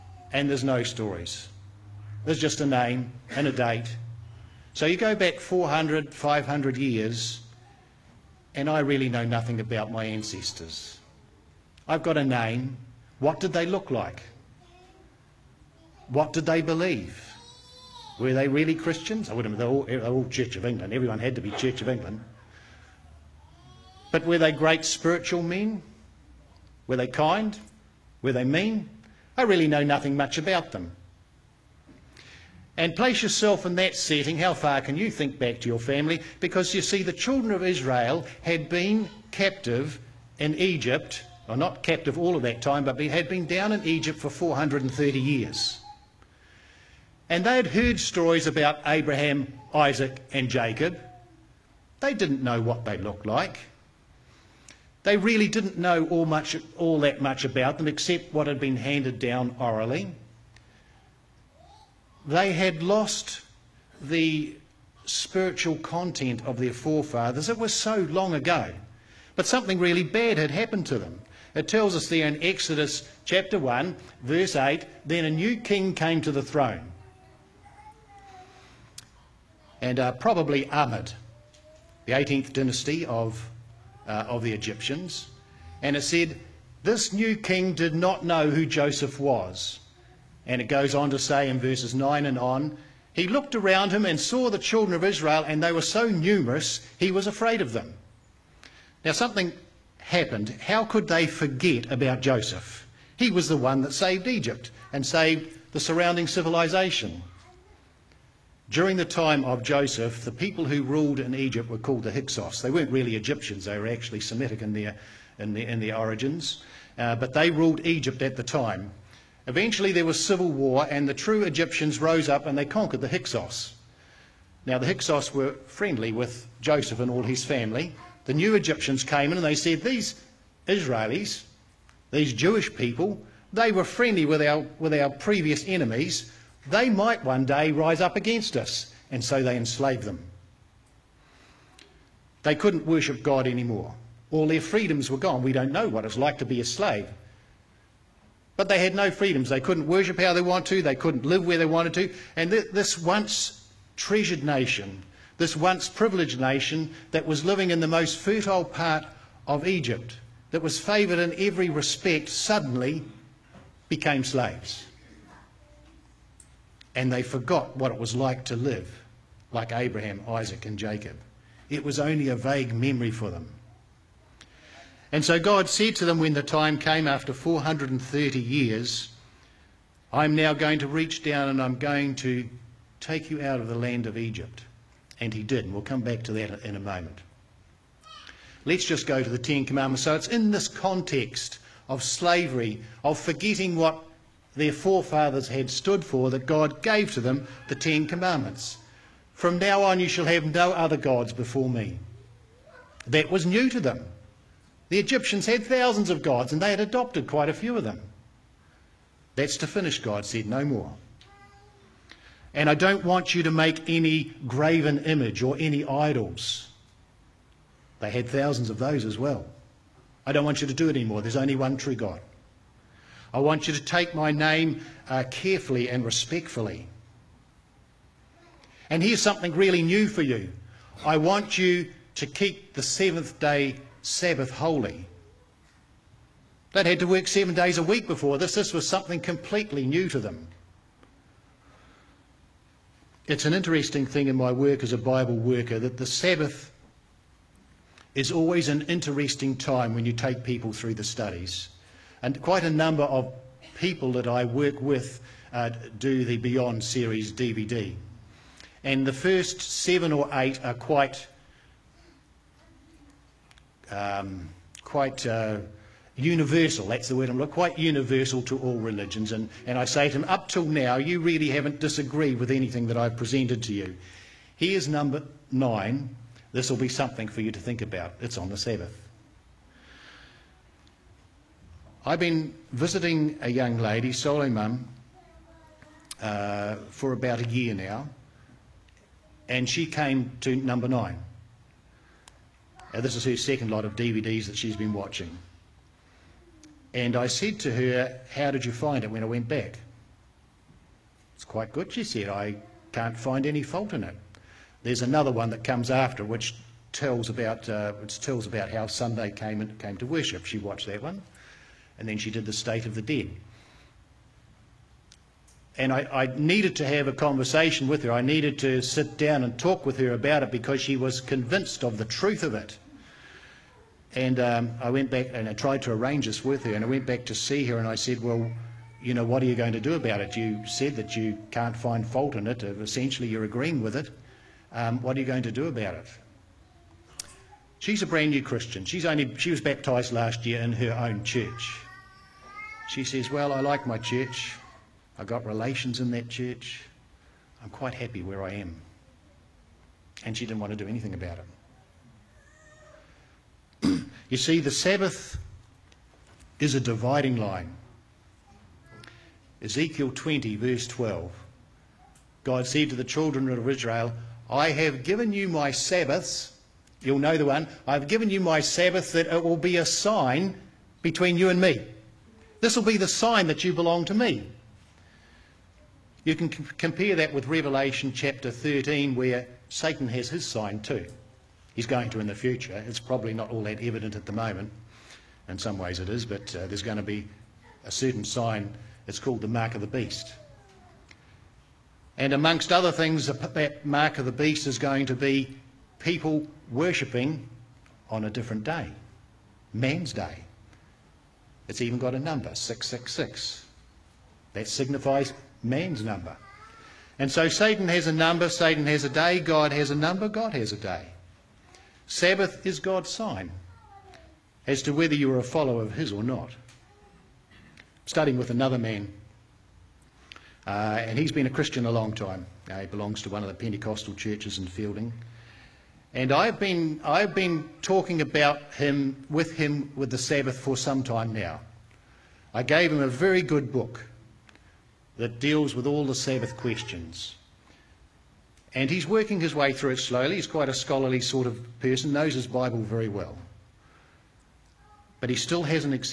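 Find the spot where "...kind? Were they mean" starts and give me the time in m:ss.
0:27.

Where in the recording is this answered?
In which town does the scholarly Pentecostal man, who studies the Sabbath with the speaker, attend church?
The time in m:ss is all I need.
7:04.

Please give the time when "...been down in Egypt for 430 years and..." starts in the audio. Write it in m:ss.
0:43.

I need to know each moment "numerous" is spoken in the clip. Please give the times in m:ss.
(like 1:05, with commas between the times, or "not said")
1:36.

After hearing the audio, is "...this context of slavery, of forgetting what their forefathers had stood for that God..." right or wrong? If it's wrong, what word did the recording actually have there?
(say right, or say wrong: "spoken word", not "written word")
right.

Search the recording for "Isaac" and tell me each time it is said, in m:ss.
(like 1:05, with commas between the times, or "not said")
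0:49, 2:50.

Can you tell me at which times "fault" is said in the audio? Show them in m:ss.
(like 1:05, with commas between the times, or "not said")
5:03, 5:32.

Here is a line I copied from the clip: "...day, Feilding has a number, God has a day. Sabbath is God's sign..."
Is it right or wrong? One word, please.
wrong.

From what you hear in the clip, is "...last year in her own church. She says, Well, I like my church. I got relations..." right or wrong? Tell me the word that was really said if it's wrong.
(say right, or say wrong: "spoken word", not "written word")
right.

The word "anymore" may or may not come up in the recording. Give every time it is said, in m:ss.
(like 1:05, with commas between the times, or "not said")
2:23, 3:40.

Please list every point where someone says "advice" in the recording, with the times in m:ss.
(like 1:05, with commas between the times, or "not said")
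not said.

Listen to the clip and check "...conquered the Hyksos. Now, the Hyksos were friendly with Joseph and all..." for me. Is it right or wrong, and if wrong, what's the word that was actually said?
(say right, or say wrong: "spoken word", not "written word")
right.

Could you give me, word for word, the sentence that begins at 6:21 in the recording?
He's going to in the future.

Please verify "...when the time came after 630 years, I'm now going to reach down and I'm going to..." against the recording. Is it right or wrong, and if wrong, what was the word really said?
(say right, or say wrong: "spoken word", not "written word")
wrong: "430", not "630".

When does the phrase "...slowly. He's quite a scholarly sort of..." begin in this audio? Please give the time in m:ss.
7:19.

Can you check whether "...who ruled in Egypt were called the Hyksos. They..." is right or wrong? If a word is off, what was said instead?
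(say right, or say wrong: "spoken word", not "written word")
right.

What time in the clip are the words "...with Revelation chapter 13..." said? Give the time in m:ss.
6:17.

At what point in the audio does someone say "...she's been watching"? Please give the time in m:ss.
4:54.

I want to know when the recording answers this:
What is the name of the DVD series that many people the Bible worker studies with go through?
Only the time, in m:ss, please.
4:16.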